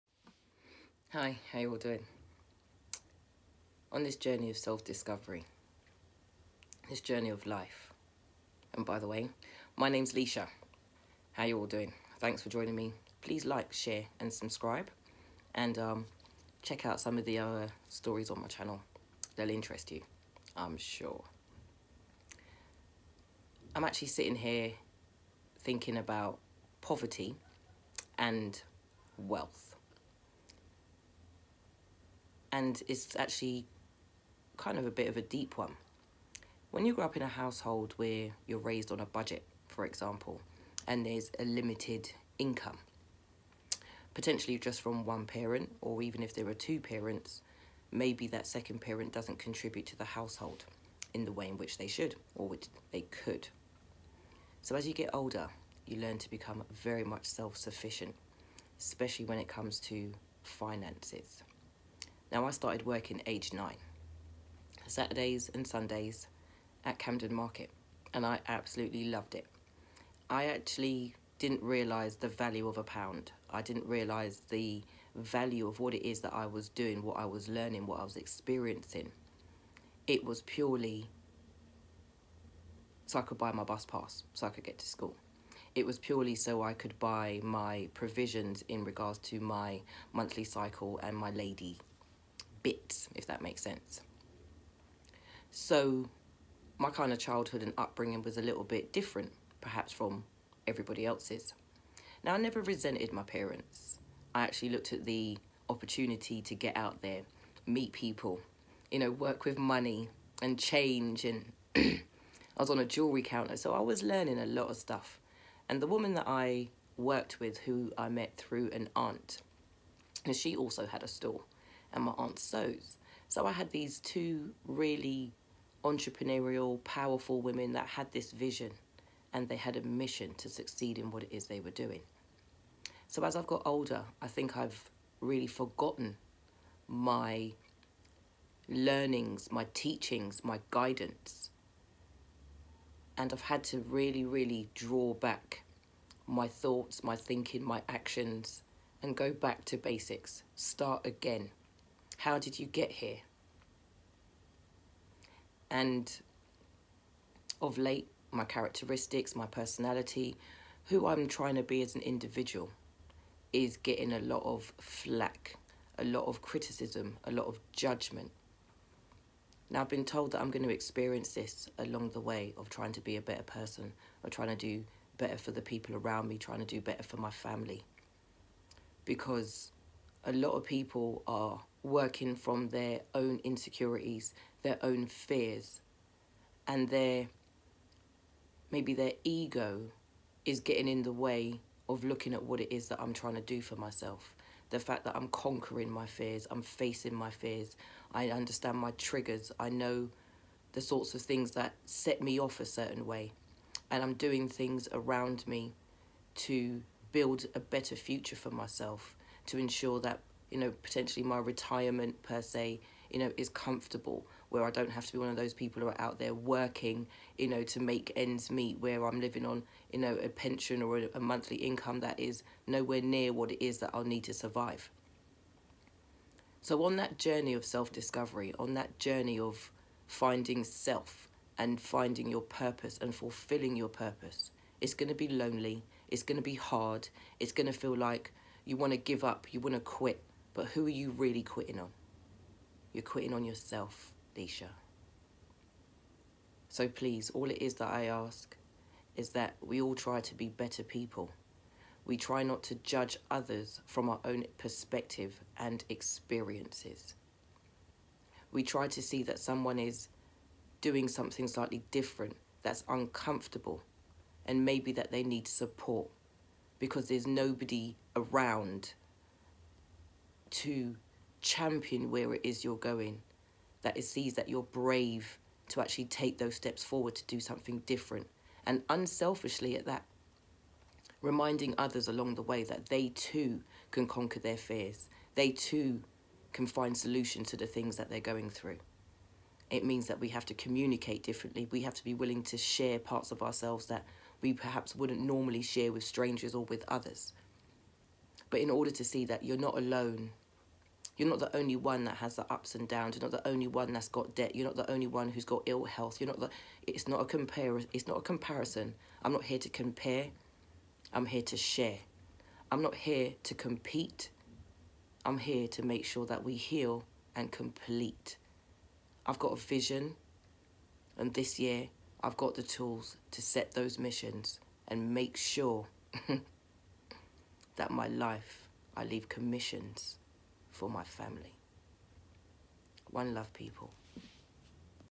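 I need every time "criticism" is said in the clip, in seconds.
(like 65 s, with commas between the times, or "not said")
166 s.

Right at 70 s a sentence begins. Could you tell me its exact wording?
I actually didn't realise the value of a pound.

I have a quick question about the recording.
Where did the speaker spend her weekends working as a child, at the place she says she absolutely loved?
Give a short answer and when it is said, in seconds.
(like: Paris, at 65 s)
Camden Market, at 66 s.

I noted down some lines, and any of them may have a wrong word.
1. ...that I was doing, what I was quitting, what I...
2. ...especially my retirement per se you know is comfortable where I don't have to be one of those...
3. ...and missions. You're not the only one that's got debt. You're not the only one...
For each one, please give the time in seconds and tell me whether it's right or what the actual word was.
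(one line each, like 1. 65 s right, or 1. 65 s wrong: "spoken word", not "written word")
1. 76 s wrong: "learning", not "quitting"
2. 210 s wrong: "potentially", not "especially"
3. 302 s wrong: "downs", not "missions".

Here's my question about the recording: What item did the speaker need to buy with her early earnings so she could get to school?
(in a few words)
Bus pass.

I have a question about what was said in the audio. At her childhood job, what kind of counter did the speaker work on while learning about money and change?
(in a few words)
Jewelry counter.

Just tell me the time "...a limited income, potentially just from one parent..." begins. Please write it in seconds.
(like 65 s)
41 s.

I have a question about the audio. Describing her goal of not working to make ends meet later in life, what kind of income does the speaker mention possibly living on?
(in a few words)
Pension.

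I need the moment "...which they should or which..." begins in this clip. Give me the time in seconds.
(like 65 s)
51 s.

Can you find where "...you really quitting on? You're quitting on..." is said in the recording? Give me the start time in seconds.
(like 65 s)
240 s.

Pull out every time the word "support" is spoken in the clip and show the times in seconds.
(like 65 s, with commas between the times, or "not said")
265 s.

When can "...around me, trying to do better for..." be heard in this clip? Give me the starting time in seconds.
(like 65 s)
175 s.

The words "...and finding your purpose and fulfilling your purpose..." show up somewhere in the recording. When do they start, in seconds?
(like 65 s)
231 s.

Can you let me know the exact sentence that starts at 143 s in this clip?
And I've had to really, really draw back my thoughts, my thinking, my actions, and go back to basics.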